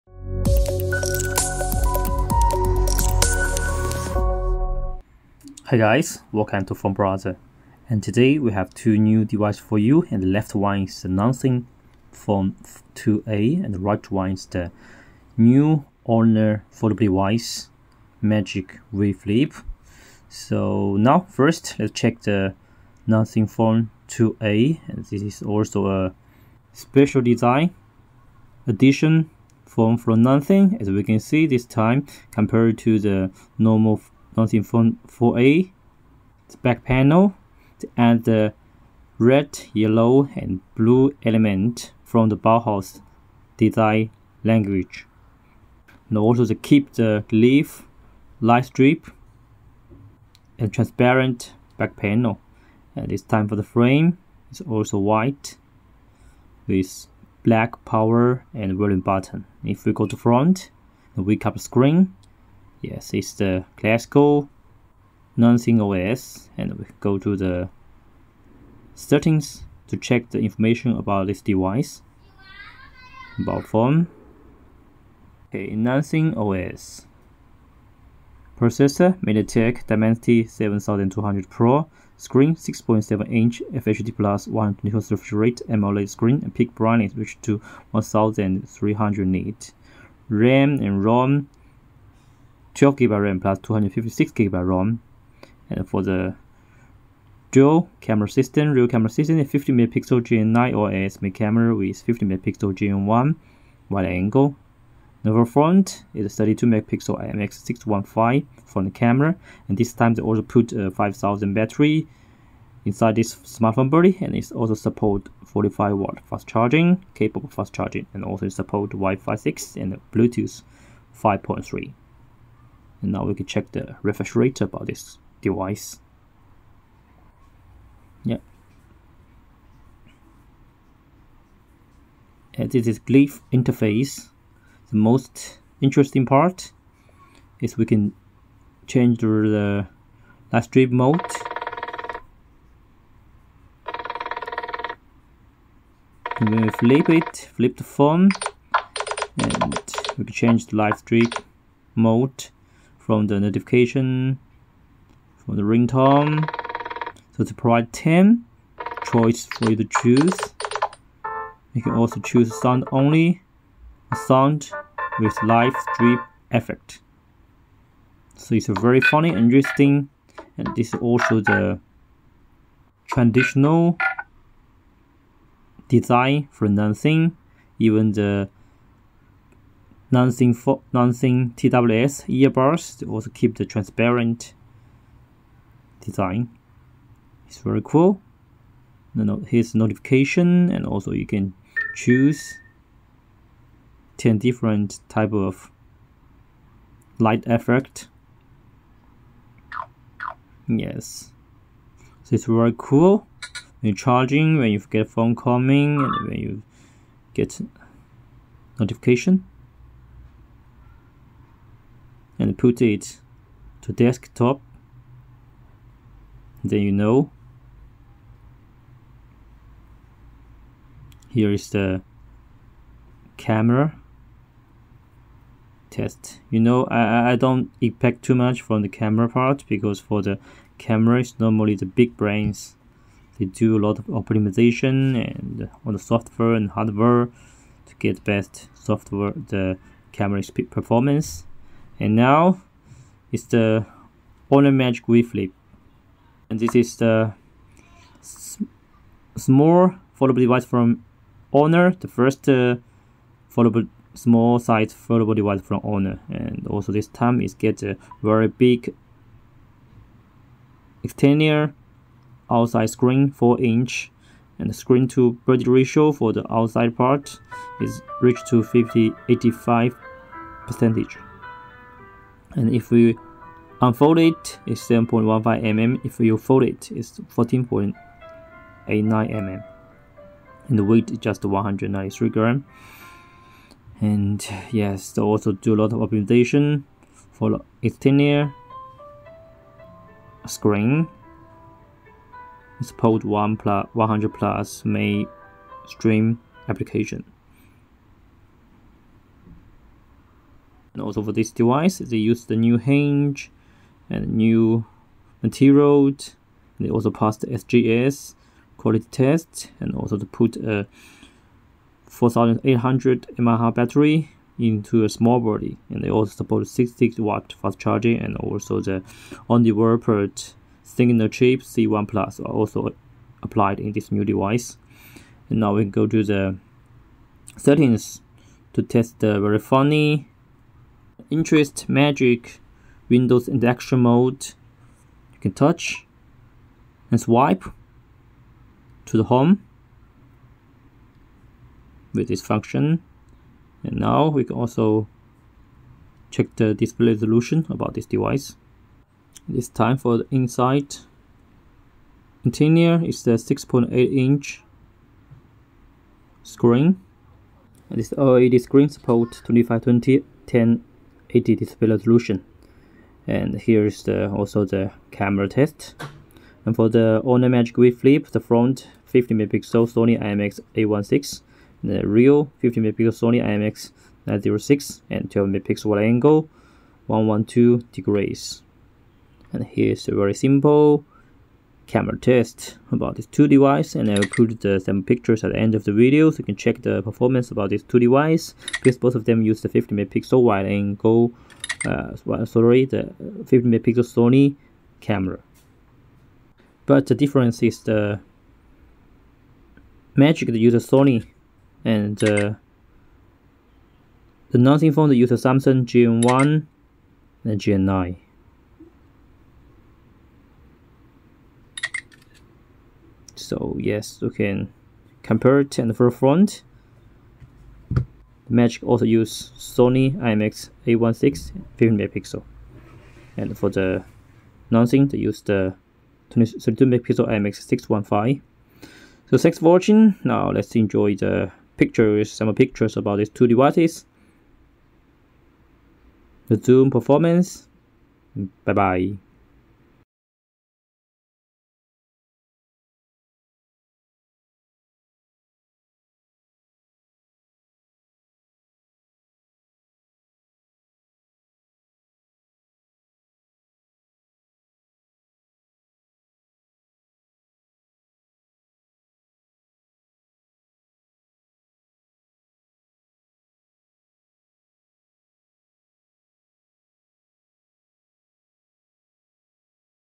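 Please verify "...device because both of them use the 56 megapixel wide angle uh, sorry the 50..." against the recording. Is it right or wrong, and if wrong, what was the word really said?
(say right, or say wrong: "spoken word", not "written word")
wrong: "50", not "56".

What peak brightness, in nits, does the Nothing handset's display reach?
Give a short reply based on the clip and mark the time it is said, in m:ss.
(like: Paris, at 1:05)
1300, at 1:27.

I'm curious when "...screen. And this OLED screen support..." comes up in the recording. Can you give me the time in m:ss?
5:56.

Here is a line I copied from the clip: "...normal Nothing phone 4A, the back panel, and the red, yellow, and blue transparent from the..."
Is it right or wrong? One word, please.
wrong.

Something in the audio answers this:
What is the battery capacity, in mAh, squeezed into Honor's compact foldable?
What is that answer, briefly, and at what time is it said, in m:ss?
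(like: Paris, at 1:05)
4800, at 5:12.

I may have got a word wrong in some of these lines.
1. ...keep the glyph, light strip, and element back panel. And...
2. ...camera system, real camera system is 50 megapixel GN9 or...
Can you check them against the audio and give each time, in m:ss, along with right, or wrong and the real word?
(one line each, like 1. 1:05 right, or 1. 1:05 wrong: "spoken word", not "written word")
1. 0:46 wrong: "transparent", not "element"
2. 1:37 right.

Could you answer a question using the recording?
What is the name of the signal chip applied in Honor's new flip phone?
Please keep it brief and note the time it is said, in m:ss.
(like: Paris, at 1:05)
C1 Plus, at 5:21.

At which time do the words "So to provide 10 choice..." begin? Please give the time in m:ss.
2:37.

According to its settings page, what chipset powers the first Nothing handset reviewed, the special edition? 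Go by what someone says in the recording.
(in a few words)
MediaTek Dimensity 7200 Pro.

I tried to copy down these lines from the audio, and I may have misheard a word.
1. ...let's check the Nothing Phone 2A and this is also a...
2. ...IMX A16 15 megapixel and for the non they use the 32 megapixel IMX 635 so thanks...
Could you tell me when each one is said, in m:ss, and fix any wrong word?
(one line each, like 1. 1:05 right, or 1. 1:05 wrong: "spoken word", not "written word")
1. 0:21 right
2. 7:00 wrong: "615", not "635".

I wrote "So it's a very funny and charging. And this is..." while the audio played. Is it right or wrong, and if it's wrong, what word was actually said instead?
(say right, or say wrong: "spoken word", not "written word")
wrong: "interesting", not "charging".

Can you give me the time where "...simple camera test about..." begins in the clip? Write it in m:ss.
6:20.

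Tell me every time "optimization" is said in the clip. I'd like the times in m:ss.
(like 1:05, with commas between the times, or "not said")
3:54, 4:45.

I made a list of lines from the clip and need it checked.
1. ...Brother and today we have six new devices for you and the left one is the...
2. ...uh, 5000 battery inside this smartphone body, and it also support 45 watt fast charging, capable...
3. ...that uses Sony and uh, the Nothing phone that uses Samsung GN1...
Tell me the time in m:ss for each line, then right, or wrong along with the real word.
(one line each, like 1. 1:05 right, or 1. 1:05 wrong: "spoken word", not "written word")
1. 0:06 wrong: "two", not "six"
2. 1:50 right
3. 6:40 right.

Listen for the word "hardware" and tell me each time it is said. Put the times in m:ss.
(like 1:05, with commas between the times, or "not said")
3:56.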